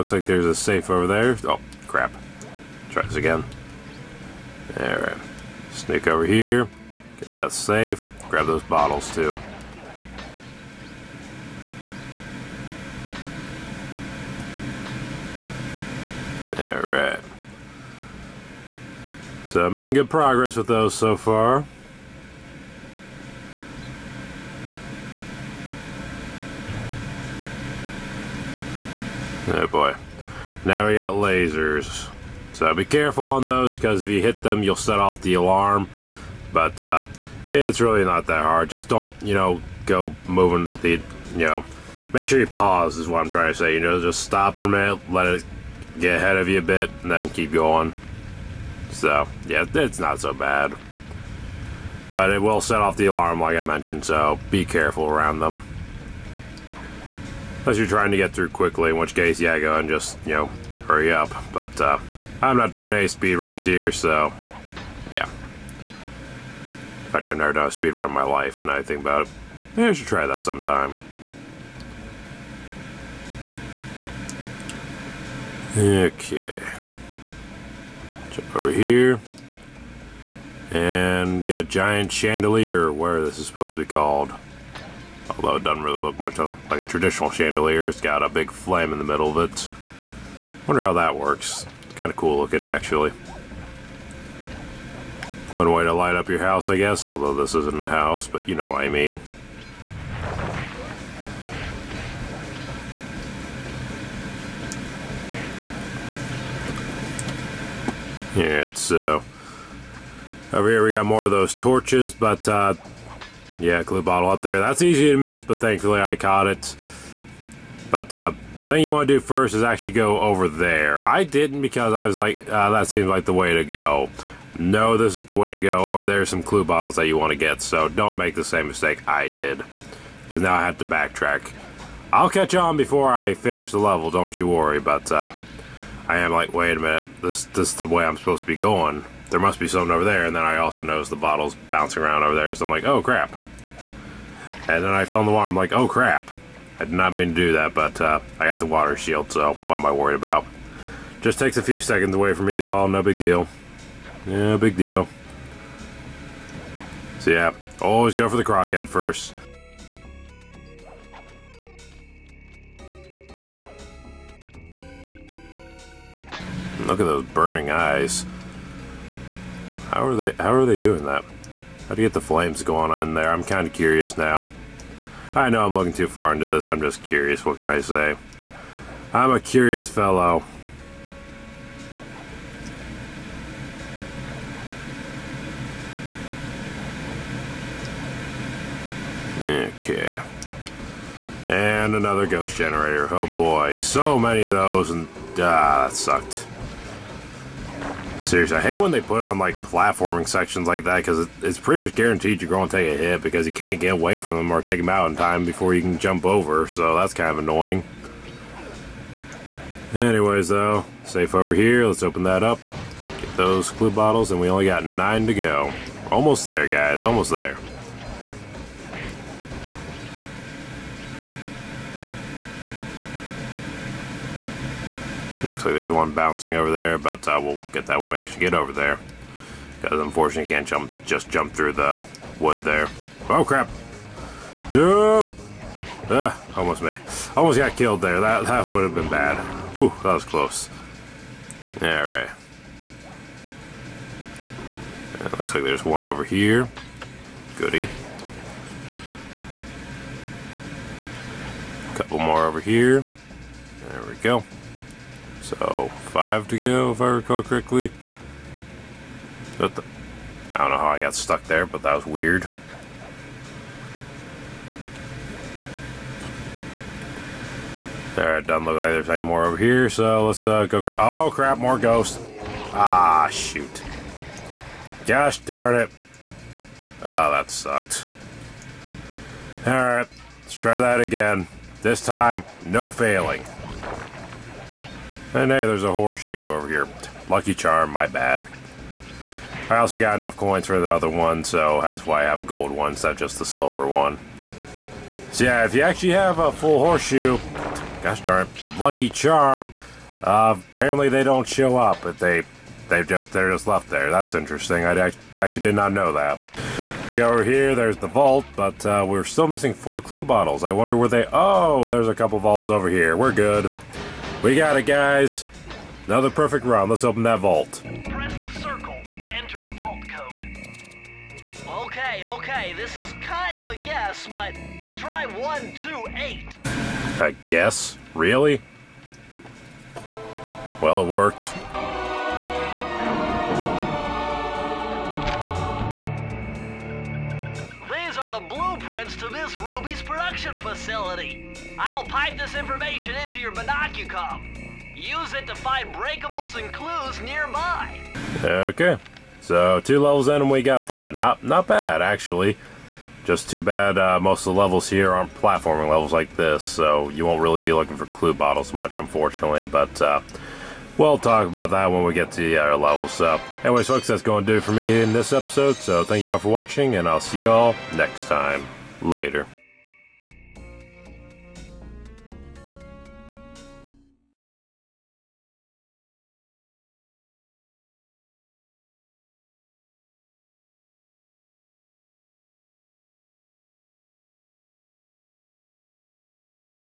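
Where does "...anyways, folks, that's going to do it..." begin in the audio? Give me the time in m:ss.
6:03.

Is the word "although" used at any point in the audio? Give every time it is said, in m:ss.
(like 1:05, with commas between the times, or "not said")
1:25, 1:37.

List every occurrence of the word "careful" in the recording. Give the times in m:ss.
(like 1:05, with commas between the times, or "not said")
0:32, 0:54.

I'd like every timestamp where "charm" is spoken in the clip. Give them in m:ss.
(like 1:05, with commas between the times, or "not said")
4:47, 4:59.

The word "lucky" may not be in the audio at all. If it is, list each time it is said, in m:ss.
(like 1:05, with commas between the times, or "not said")
4:47, 4:58.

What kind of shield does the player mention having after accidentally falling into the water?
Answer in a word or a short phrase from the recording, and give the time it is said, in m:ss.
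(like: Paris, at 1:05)
water shield, at 2:28.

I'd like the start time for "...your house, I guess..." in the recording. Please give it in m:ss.
1:36.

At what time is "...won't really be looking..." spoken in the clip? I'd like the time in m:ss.
5:57.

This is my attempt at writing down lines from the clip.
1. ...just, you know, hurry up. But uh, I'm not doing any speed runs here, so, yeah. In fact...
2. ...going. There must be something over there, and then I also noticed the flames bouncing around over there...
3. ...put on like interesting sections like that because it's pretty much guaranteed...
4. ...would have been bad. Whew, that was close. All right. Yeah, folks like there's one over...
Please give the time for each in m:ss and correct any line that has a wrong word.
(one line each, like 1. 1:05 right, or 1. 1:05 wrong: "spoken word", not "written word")
1. 0:59 right
2. 2:18 wrong: "bottles", not "flames"
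3. 3:19 wrong: "platforming", not "interesting"
4. 3:58 wrong: "looks", not "folks".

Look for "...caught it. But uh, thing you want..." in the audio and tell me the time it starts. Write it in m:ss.
1:56.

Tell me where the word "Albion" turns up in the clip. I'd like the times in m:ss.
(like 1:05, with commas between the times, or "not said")
not said.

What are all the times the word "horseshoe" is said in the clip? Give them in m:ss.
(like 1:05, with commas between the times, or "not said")
4:45, 4:56.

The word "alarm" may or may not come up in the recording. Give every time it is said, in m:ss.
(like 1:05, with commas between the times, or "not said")
0:35, 0:53.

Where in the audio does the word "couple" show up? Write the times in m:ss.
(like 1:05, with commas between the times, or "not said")
4:11, 5:12.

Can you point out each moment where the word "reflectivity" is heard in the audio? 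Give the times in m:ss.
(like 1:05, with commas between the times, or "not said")
not said.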